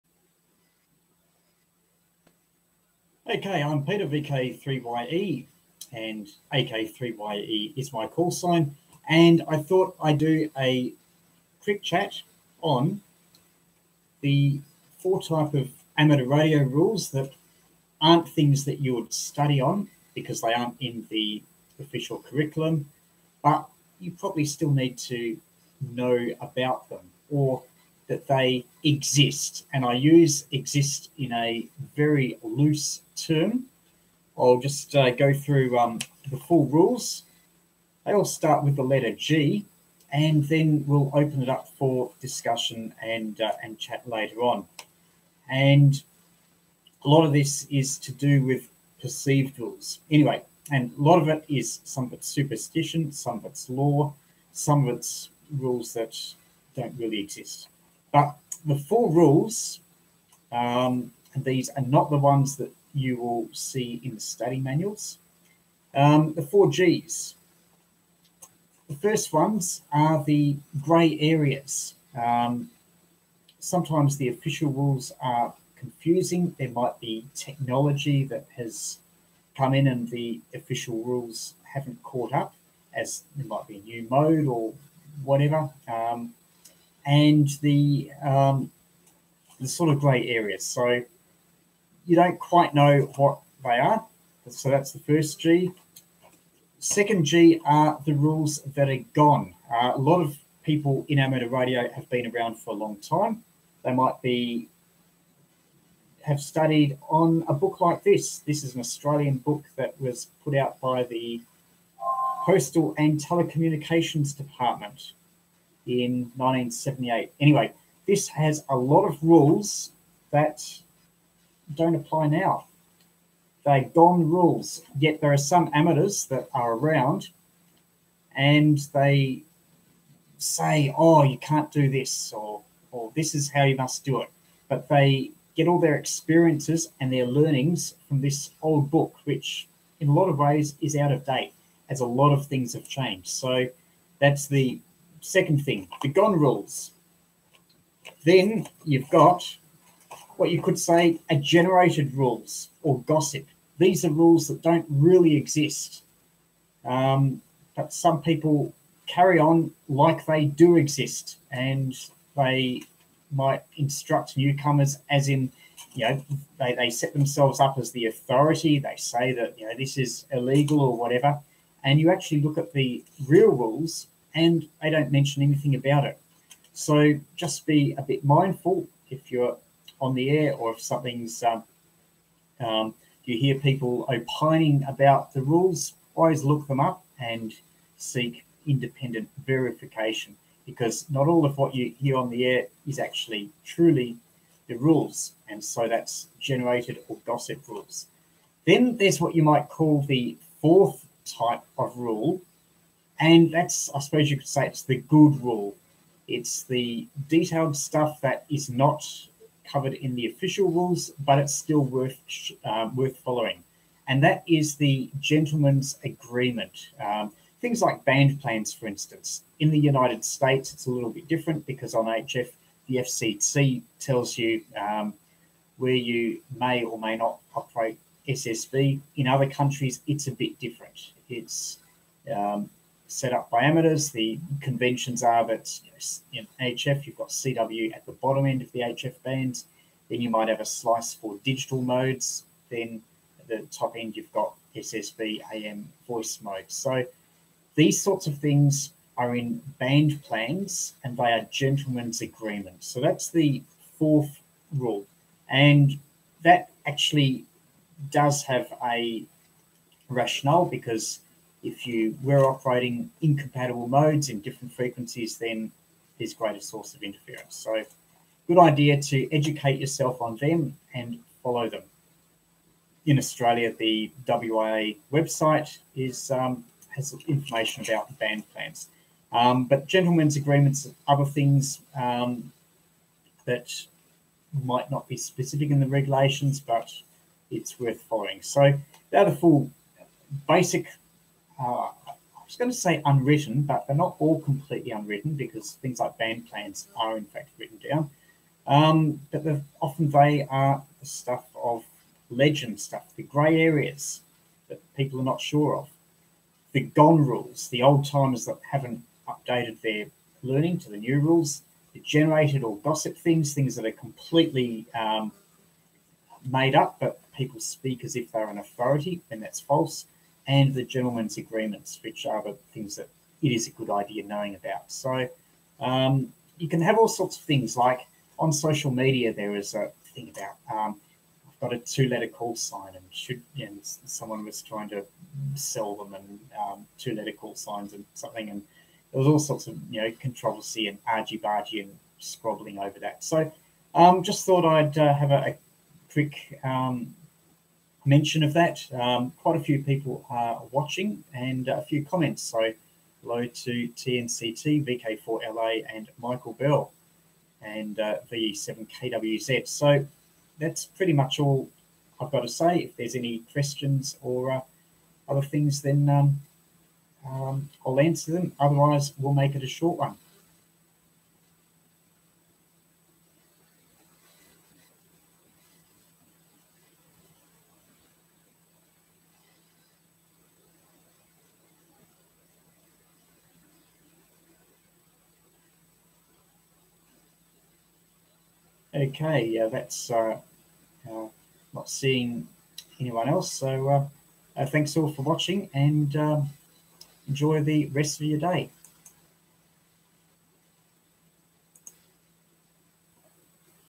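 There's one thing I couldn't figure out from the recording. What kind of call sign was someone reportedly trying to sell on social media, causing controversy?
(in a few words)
two letter call sign.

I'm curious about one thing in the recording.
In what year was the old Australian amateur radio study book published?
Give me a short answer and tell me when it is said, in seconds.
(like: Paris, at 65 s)
1978, at 116 s.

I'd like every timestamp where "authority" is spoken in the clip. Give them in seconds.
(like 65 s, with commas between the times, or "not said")
168 s, 318 s.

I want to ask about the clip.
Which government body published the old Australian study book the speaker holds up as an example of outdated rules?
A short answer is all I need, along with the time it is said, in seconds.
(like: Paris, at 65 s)
Postal and Telecommunications Department, at 112 s.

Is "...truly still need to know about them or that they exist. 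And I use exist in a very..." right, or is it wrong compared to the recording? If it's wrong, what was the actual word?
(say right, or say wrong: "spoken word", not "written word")
wrong: "probably", not "truly".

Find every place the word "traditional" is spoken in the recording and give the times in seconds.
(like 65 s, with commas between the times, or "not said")
not said.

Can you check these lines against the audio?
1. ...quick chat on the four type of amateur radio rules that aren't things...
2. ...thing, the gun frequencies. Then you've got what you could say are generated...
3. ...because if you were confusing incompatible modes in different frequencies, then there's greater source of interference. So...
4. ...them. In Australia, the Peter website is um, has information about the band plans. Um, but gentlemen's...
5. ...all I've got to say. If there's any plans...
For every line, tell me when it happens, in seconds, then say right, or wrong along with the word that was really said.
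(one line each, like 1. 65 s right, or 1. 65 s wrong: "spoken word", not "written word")
1. 11 s right
2. 145 s wrong: "rules", not "frequencies"
3. 260 s wrong: "operating", not "confusing"
4. 271 s wrong: "WIA", not "Peter"
5. 361 s wrong: "questions", not "plans".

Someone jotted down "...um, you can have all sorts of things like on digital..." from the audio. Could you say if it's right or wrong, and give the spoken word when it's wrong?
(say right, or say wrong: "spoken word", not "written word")
wrong: "social", not "digital".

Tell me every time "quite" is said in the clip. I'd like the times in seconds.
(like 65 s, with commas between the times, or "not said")
92 s, 349 s.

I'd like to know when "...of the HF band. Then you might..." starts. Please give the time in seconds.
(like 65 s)
238 s.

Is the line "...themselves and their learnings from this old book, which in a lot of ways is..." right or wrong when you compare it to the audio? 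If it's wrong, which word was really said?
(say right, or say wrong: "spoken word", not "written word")
wrong: "experiences", not "themselves".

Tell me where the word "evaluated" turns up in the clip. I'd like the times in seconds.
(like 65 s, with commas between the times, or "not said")
not said.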